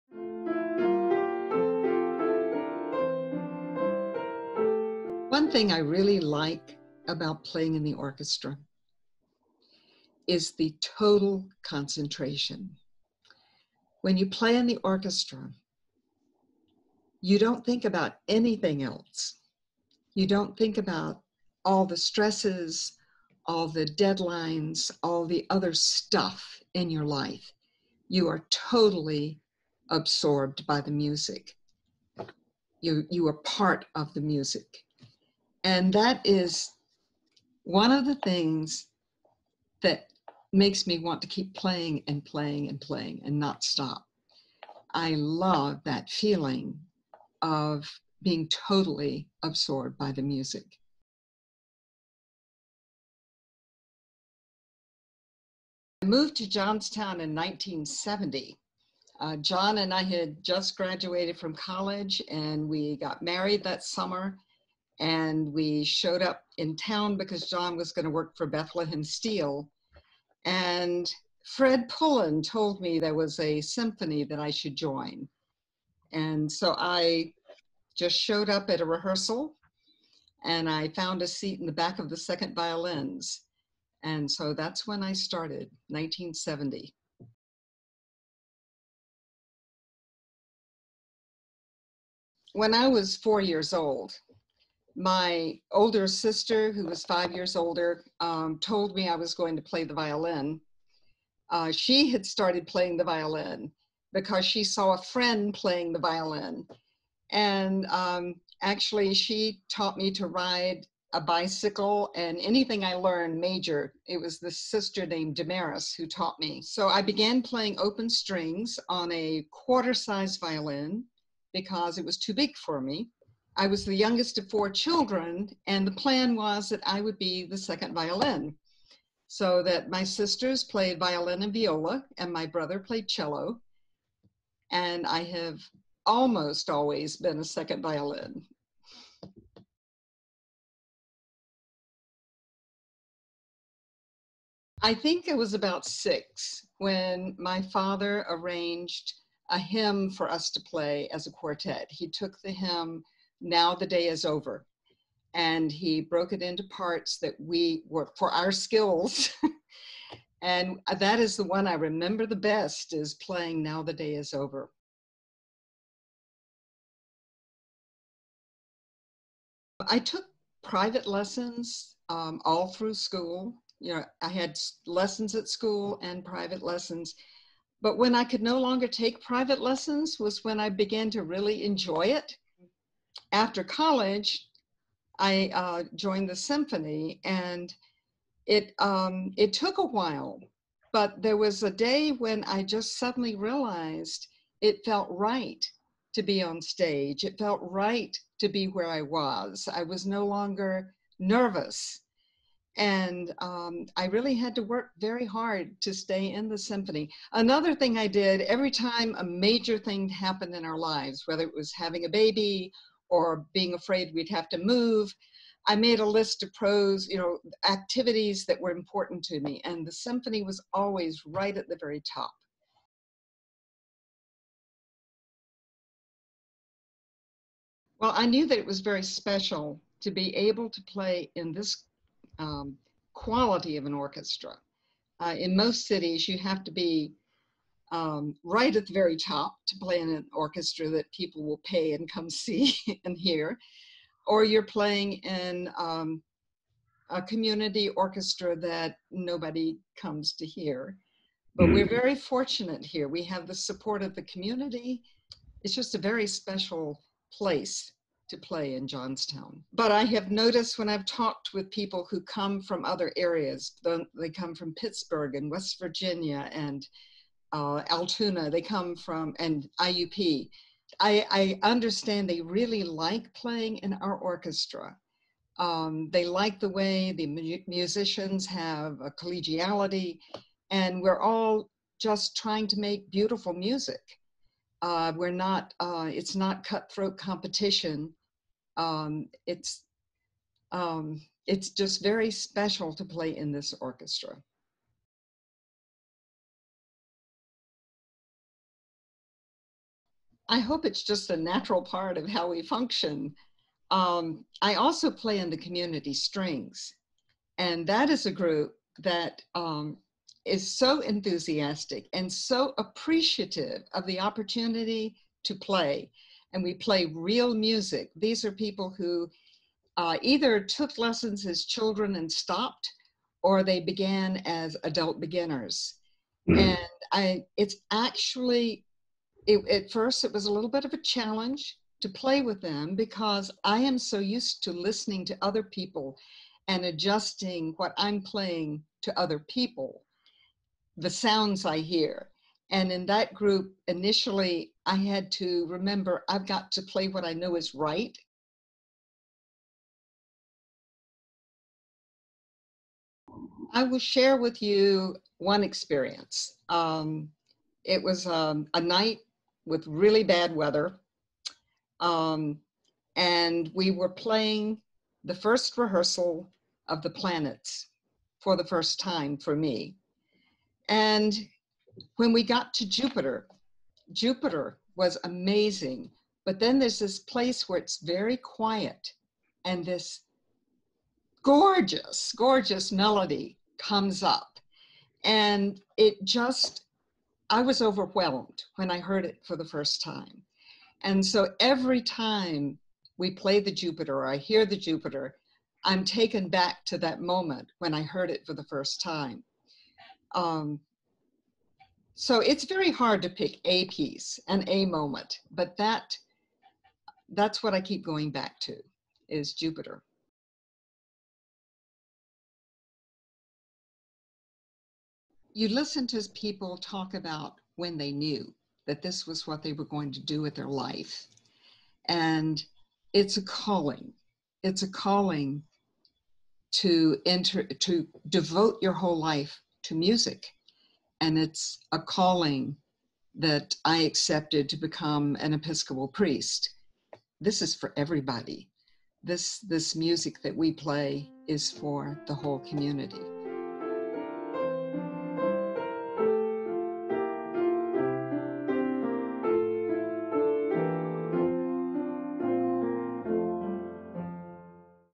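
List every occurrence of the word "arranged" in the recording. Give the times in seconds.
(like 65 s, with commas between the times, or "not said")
148 s.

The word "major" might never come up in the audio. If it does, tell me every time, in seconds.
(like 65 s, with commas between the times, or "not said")
113 s, 209 s.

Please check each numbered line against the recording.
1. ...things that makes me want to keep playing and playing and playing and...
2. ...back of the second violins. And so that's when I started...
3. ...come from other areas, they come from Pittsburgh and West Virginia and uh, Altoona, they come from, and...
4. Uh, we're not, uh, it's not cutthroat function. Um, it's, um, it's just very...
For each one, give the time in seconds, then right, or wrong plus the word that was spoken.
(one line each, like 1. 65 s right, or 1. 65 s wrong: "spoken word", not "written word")
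1. 38 s right
2. 81 s right
3. 262 s right
4. 284 s wrong: "competition", not "function".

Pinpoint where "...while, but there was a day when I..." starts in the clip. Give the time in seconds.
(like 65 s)
189 s.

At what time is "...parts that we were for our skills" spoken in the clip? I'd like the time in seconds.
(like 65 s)
156 s.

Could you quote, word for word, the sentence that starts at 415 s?
you listen to people talk about when they knew that this was what they were going to do with their life.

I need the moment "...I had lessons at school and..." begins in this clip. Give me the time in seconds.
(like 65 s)
174 s.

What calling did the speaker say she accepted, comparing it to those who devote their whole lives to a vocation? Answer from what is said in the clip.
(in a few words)
Episcopal priest.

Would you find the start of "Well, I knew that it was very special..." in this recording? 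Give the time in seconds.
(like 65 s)
227 s.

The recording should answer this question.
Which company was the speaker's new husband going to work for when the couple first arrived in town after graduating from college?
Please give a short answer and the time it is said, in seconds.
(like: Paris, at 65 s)
Bethlehem Steel, at 68 s.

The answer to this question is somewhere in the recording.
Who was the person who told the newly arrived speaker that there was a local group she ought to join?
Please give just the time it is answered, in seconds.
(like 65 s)
71 s.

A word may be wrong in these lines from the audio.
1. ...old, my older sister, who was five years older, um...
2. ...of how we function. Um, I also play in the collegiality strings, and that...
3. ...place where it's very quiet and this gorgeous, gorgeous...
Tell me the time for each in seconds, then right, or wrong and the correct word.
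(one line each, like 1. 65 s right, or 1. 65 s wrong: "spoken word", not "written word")
1. 93 s right
2. 302 s wrong: "community", not "collegiality"
3. 377 s right.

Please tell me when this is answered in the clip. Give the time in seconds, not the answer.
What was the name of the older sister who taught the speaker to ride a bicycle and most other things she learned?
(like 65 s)
115 s.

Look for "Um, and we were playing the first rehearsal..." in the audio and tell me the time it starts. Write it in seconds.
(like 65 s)
361 s.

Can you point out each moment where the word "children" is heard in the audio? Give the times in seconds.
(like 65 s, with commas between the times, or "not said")
124 s, 321 s.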